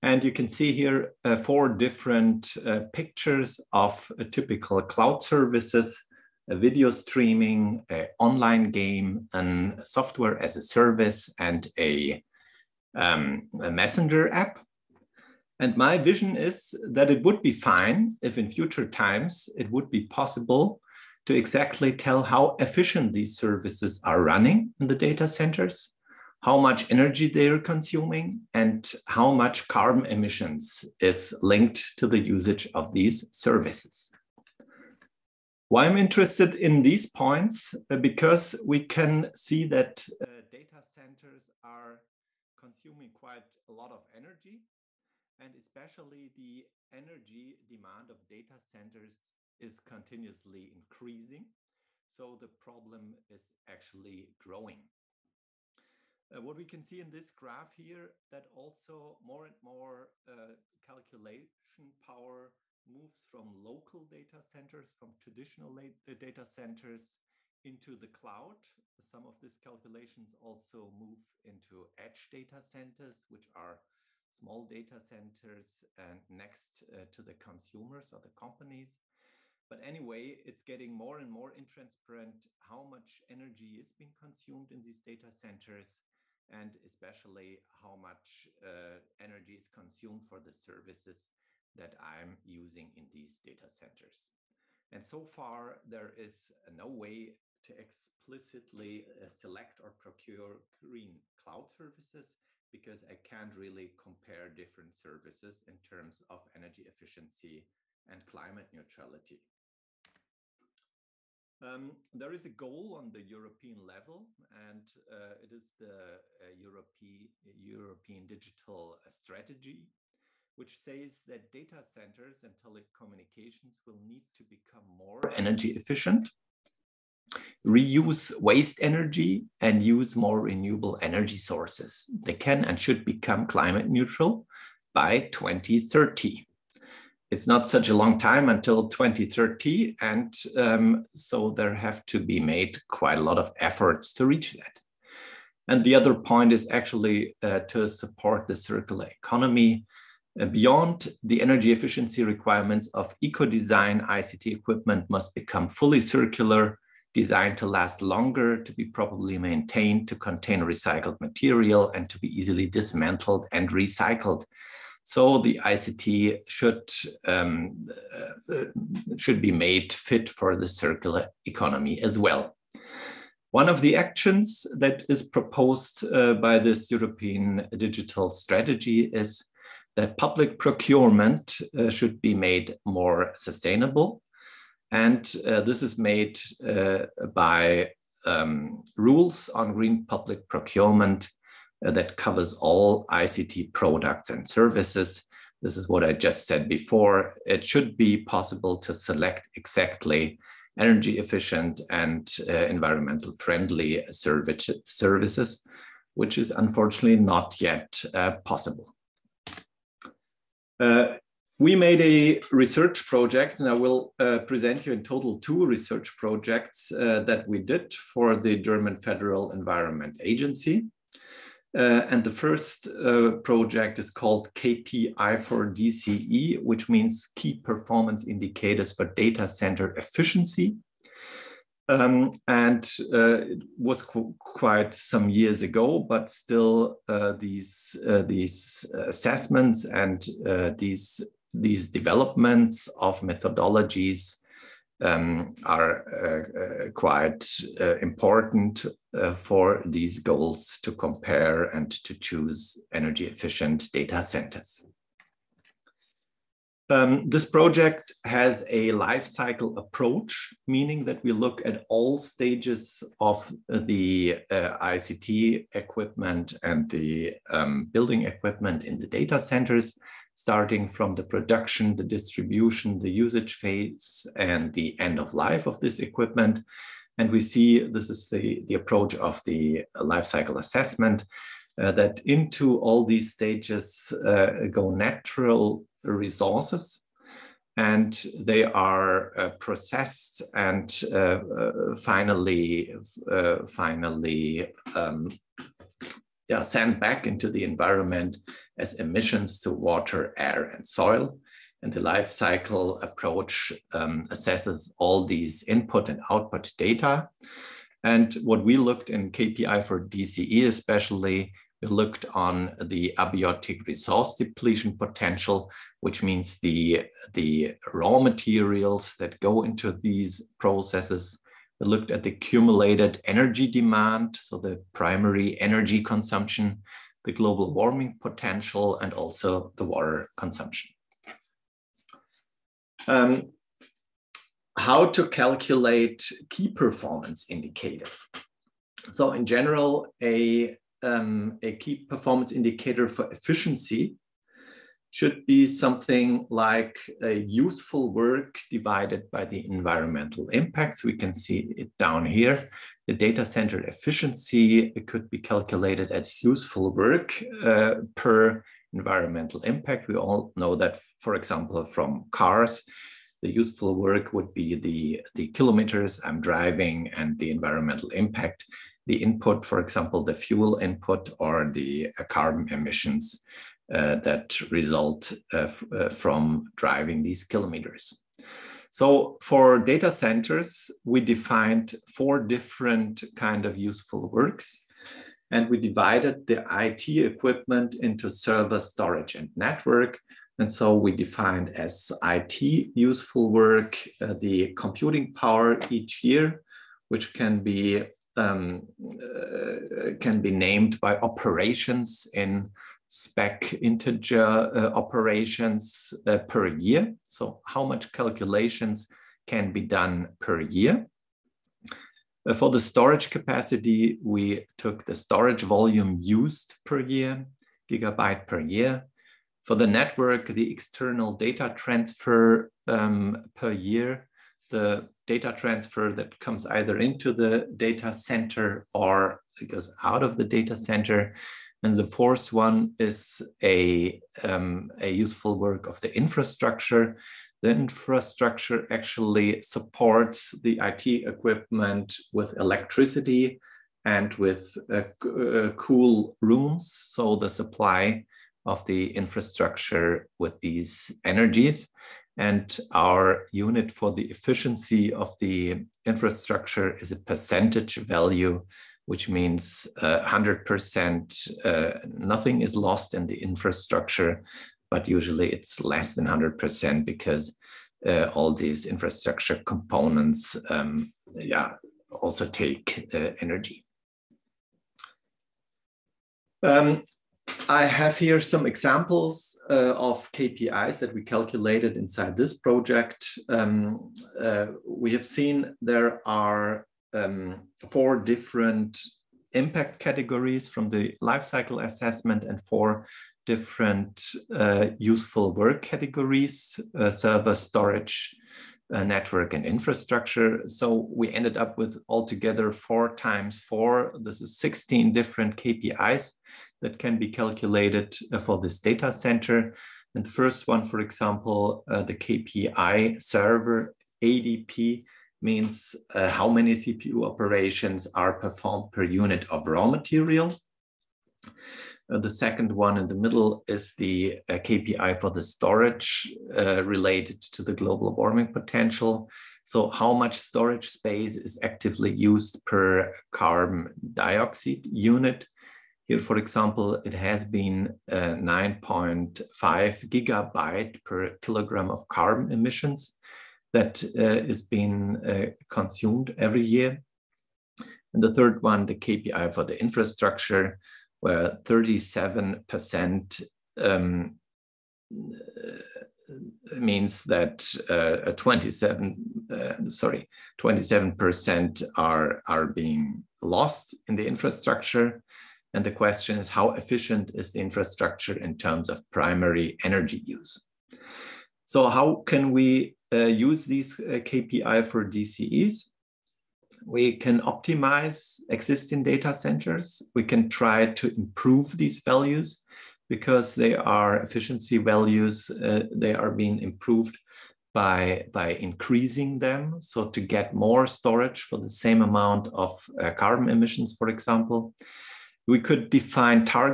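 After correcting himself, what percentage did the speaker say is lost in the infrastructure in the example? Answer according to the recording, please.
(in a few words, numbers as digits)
27%.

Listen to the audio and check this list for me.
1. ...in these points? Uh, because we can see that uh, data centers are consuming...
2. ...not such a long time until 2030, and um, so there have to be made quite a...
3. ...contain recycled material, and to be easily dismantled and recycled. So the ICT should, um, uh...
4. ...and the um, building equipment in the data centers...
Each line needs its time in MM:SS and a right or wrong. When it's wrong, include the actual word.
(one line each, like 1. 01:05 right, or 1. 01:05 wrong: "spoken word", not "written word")
1. 00:36 right
2. 02:17 right
3. 02:40 right
4. 04:26 right.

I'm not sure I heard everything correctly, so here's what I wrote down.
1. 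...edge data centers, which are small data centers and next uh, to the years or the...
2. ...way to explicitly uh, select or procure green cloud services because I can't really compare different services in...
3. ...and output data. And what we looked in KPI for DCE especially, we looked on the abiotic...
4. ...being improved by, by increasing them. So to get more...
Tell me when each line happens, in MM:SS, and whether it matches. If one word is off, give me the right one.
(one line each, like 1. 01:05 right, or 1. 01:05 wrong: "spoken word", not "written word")
1. 01:11 wrong: "consumers", not "years"
2. 01:36 right
3. 05:06 right
4. 09:46 right.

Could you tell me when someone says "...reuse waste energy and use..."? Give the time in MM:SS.
02:07.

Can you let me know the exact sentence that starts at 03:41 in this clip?
Uh, and the first uh, project is called KPI for DCE, which means Key Performance Indicators for Data Center Efficiency.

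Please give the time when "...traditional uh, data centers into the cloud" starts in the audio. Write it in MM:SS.
01:05.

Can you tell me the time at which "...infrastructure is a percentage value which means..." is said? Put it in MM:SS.
07:36.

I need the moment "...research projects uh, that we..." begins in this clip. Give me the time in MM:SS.
03:35.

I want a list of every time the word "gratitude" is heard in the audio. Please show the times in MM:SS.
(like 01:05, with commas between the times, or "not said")
not said.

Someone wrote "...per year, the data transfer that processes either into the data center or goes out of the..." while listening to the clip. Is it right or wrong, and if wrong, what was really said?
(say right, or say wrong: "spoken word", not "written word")
wrong: "comes", not "processes".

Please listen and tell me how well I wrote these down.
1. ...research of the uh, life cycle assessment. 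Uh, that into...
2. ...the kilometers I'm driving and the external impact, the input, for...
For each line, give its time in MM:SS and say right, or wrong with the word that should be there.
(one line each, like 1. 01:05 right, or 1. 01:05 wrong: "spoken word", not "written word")
1. 04:38 wrong: "approach", not "research"
2. 06:05 wrong: "environmental", not "external".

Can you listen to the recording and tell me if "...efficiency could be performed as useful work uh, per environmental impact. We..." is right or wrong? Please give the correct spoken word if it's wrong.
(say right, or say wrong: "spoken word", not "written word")
wrong: "calculated", not "performed".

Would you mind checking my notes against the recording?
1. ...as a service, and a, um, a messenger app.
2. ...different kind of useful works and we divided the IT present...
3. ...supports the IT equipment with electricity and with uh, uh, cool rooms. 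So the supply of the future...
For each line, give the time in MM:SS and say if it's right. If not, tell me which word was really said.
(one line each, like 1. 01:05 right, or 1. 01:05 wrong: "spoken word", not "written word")
1. 00:10 right
2. 06:22 wrong: "equipment", not "present"
3. 07:19 wrong: "infrastructure", not "future".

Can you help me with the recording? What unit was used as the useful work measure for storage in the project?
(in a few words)
gigabyte per year.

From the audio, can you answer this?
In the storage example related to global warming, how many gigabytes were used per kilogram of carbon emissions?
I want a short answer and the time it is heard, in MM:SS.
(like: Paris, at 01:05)
9.5, at 08:58.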